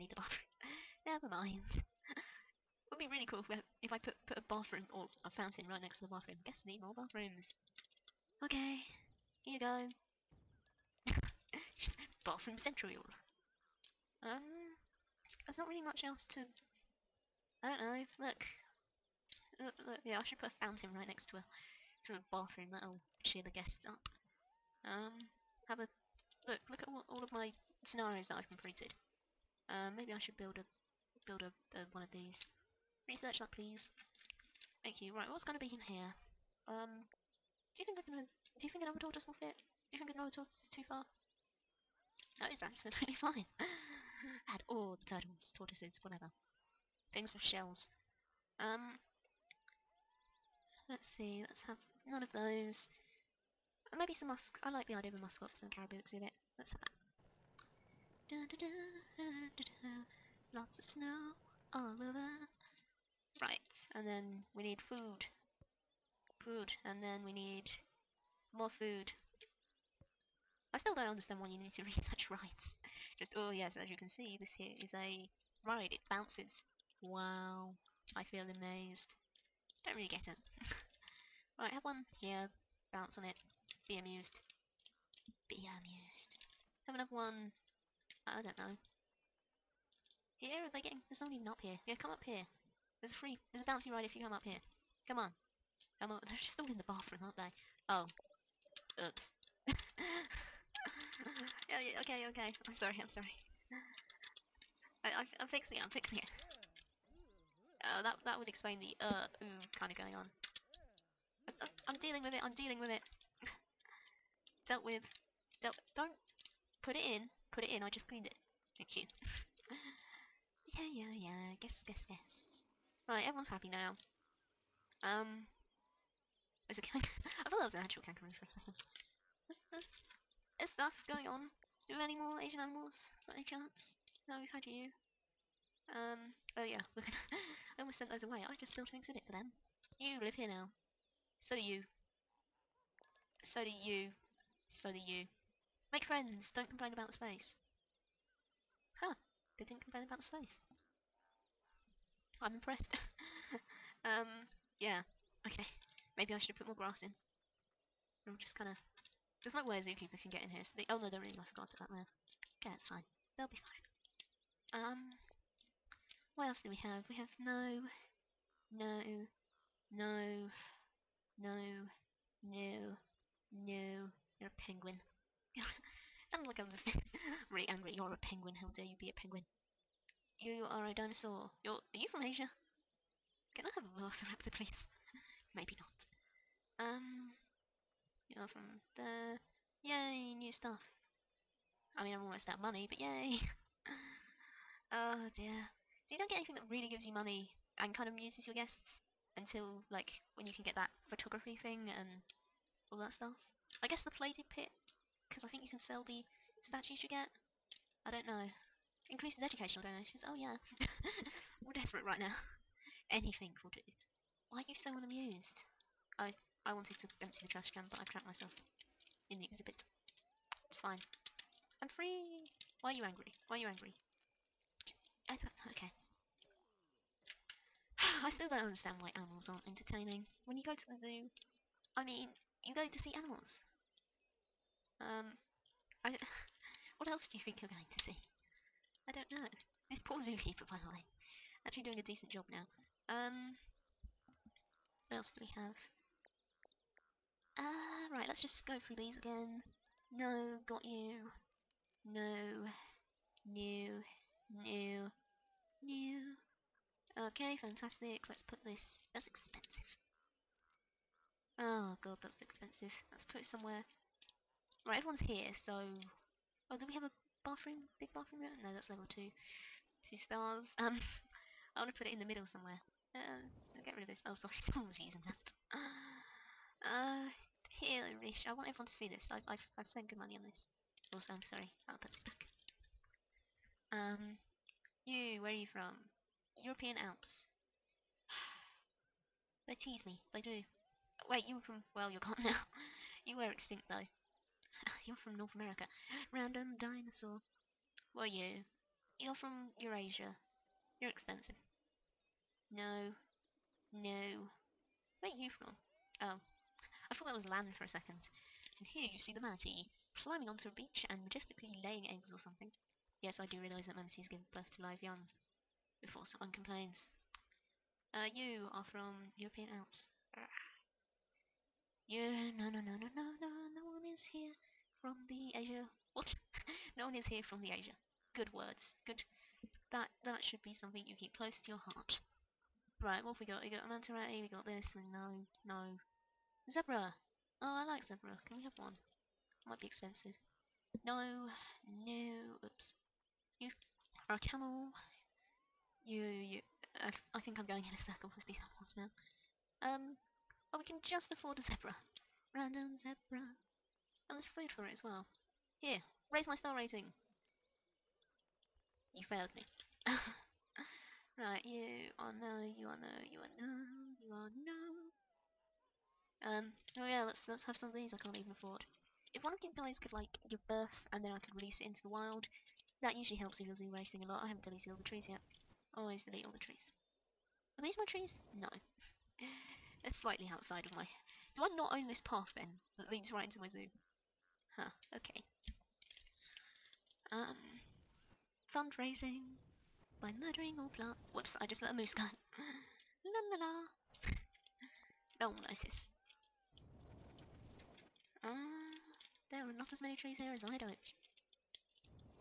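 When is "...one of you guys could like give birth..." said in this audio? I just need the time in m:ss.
6:09.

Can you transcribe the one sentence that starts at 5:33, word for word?
We got a manta we got this, and no, no.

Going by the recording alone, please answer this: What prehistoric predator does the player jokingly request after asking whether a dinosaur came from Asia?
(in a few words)
Velociraptor.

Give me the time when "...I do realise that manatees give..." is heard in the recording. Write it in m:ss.
5:13.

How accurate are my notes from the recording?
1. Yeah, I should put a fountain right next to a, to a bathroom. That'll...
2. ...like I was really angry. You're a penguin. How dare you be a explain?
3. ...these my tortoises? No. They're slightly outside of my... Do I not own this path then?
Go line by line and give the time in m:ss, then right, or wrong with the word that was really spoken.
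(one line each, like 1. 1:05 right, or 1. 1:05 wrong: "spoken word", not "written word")
1. 0:20 right
2. 2:56 wrong: "penguin", not "explain"
3. 6:17 wrong: "trees", not "tortoises".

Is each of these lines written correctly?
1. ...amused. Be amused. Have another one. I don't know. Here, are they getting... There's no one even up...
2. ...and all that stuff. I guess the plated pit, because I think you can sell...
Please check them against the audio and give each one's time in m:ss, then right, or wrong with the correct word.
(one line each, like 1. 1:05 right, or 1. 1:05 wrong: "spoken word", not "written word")
1. 1:23 right
2. 3:21 right.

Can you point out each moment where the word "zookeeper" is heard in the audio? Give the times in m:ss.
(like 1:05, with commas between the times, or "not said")
2:39, 4:00.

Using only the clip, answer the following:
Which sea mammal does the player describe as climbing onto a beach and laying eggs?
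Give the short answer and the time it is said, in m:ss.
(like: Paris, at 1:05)
Manatee, at 5:09.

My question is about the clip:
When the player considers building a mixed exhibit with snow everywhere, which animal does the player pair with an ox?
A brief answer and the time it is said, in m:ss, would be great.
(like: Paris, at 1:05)
Caribou, at 0:55.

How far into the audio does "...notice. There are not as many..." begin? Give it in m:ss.
6:35.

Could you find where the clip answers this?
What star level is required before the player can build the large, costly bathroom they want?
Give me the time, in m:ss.
4:30.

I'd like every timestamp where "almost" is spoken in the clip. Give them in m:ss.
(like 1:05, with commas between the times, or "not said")
2:17, 3:12.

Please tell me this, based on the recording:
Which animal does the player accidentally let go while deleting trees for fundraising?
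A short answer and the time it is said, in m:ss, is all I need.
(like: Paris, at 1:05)
Moose, at 6:31.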